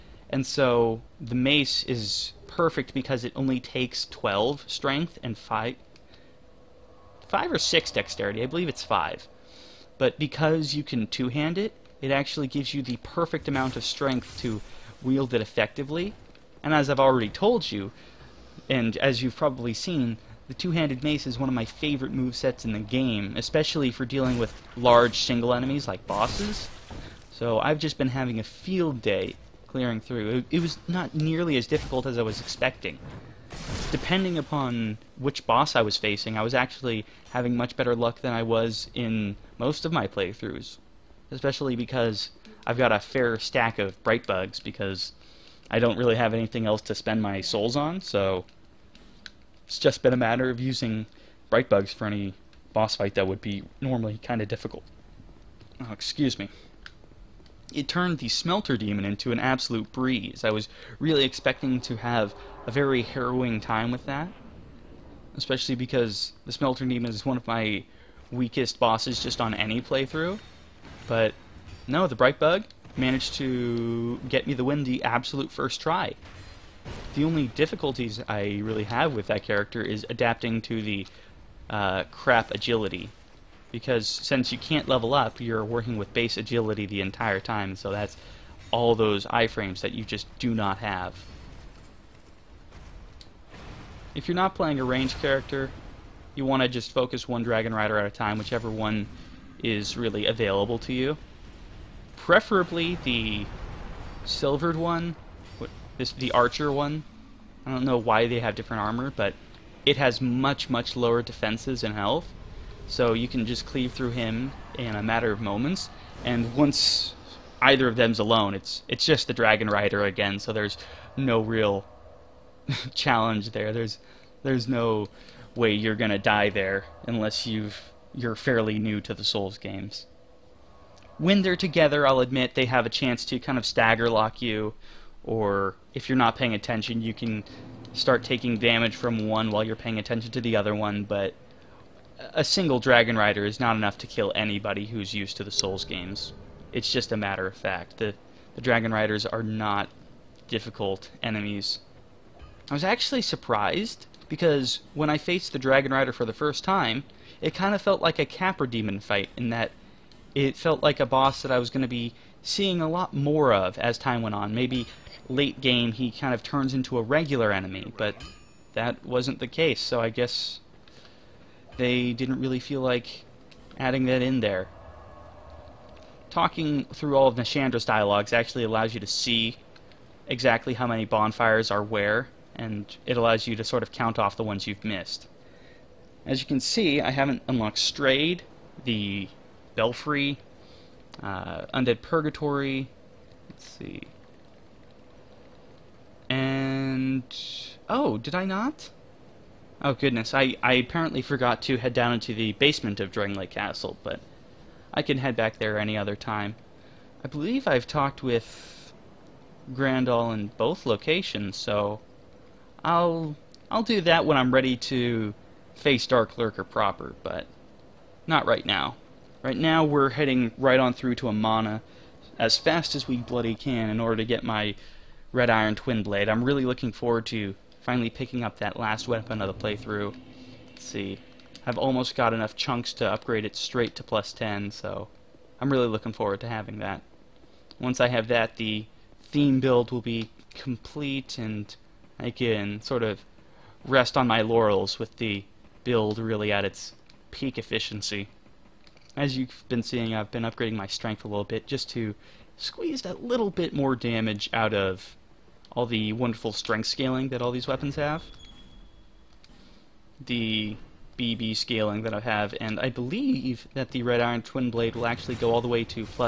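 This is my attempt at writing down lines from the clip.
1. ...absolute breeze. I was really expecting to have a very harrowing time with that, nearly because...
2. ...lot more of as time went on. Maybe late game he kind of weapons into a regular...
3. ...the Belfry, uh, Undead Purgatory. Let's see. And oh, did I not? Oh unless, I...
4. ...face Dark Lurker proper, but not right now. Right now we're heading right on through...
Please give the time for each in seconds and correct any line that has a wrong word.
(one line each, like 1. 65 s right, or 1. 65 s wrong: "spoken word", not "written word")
1. 59 s wrong: "especially", not "nearly"
2. 162 s wrong: "turns", not "weapons"
3. 188 s wrong: "goodness", not "unless"
4. 215 s right.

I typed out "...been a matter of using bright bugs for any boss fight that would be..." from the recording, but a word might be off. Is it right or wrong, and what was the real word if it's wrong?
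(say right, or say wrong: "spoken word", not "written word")
right.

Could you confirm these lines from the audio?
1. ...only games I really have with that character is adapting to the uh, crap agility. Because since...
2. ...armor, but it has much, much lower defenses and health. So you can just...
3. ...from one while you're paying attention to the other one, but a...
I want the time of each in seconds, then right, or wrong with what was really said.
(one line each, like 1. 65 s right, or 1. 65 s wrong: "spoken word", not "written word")
1. 77 s wrong: "difficulties", not "games"
2. 108 s right
3. 138 s right.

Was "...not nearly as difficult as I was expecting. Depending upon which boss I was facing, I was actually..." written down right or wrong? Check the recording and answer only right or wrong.
right.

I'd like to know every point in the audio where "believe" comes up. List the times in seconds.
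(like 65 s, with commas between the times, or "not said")
8 s, 207 s, 262 s.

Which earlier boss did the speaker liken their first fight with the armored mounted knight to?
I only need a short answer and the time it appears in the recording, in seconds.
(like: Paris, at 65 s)
Capra Demon, at 158 s.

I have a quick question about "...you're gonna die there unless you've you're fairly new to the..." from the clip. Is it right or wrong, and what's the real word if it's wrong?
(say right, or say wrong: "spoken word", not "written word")
right.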